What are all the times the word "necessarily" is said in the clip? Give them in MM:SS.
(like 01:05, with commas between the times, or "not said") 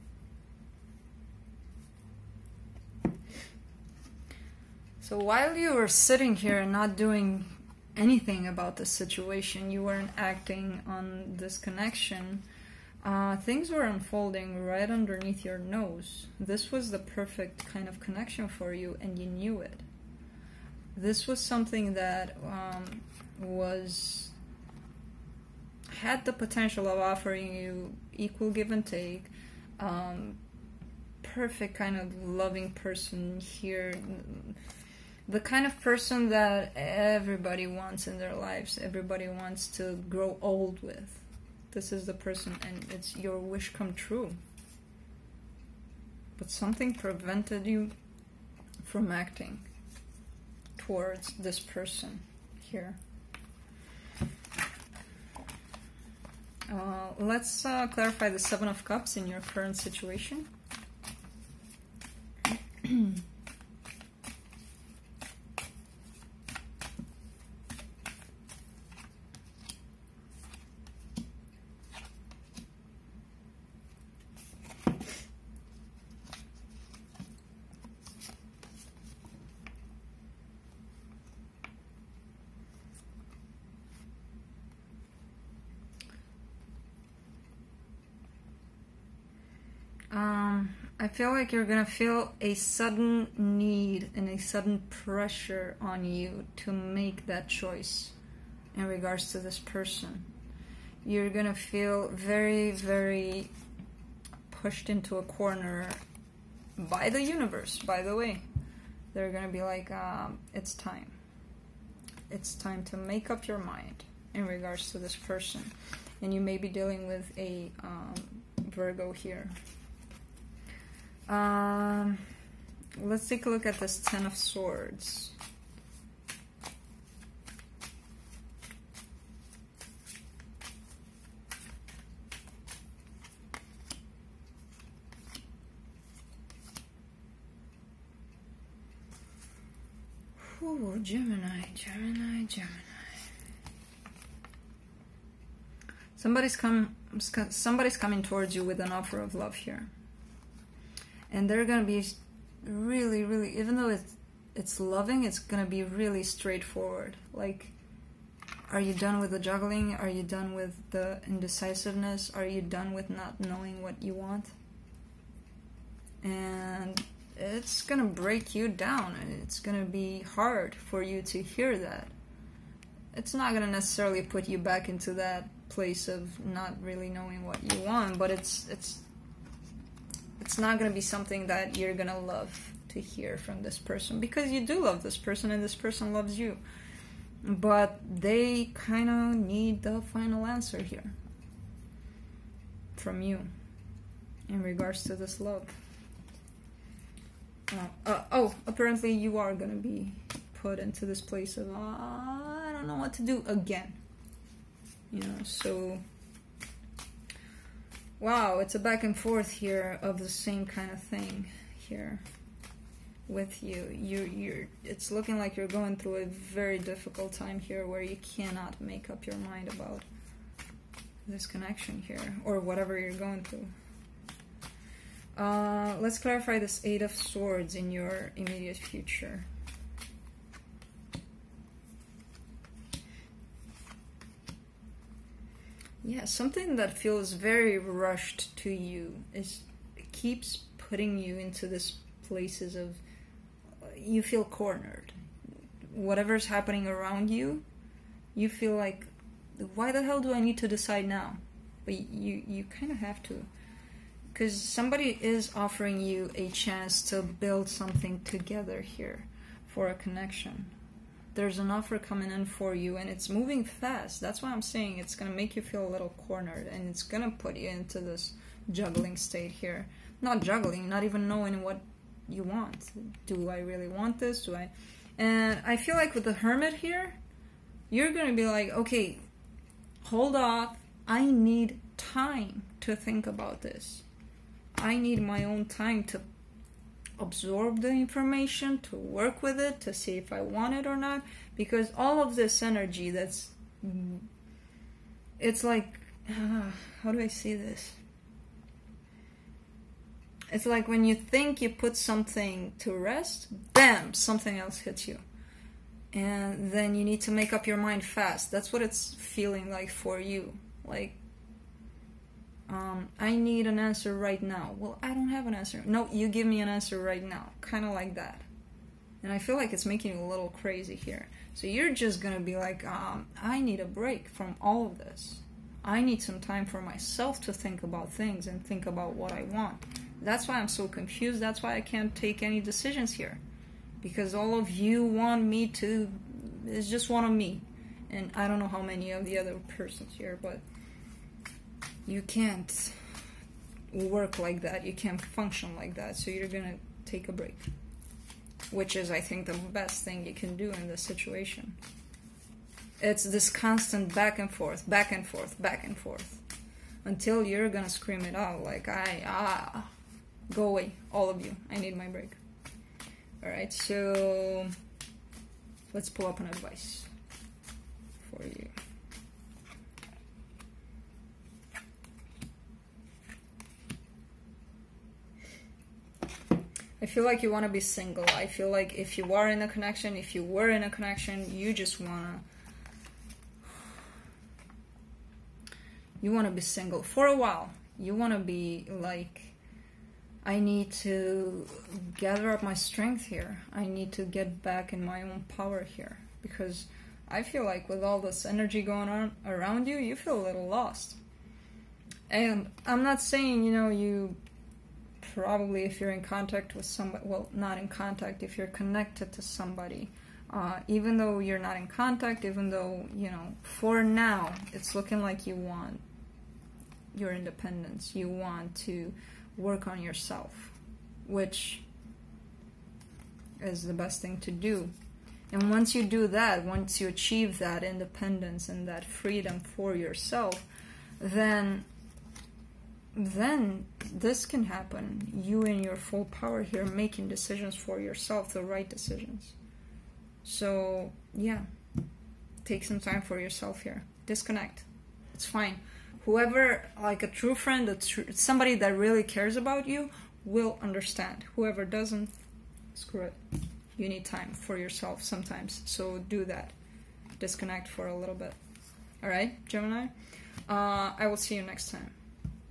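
02:53.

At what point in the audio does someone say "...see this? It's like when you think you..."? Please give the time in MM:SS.
04:57.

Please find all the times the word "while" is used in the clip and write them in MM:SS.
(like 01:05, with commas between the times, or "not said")
00:05, 06:27.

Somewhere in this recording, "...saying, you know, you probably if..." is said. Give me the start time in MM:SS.
06:43.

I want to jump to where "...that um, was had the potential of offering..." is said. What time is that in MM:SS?
00:21.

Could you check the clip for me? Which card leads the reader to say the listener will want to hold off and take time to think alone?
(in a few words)
The Hermit.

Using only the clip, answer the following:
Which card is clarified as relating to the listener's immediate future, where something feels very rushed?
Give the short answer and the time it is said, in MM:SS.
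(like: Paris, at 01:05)
Eight of Swords, at 03:46.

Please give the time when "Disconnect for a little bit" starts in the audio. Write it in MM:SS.
07:37.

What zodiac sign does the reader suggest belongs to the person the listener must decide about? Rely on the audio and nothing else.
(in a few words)
Virgo.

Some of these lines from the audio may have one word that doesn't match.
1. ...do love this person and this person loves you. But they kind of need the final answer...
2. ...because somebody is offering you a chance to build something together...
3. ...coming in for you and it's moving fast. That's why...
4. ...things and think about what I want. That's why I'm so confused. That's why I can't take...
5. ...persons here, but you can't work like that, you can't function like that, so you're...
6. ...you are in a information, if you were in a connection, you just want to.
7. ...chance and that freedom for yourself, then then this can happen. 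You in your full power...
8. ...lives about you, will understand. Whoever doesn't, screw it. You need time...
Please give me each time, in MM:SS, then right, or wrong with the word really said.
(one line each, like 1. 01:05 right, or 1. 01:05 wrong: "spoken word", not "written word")
1. 03:04 right
2. 04:14 right
3. 04:21 right
4. 05:28 right
5. 05:39 right
6. 06:19 wrong: "connection", not "information"
7. 07:07 wrong: "independence", not "chance"
8. 07:29 wrong: "cares", not "lives".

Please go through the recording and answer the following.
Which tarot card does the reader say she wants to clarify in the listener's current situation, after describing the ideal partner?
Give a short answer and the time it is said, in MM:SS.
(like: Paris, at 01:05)
Seven of Cups, at 00:58.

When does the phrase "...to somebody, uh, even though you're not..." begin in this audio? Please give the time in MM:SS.
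06:49.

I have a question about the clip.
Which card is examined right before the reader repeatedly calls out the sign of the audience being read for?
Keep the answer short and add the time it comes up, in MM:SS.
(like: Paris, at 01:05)
Ten of Swords, at 02:03.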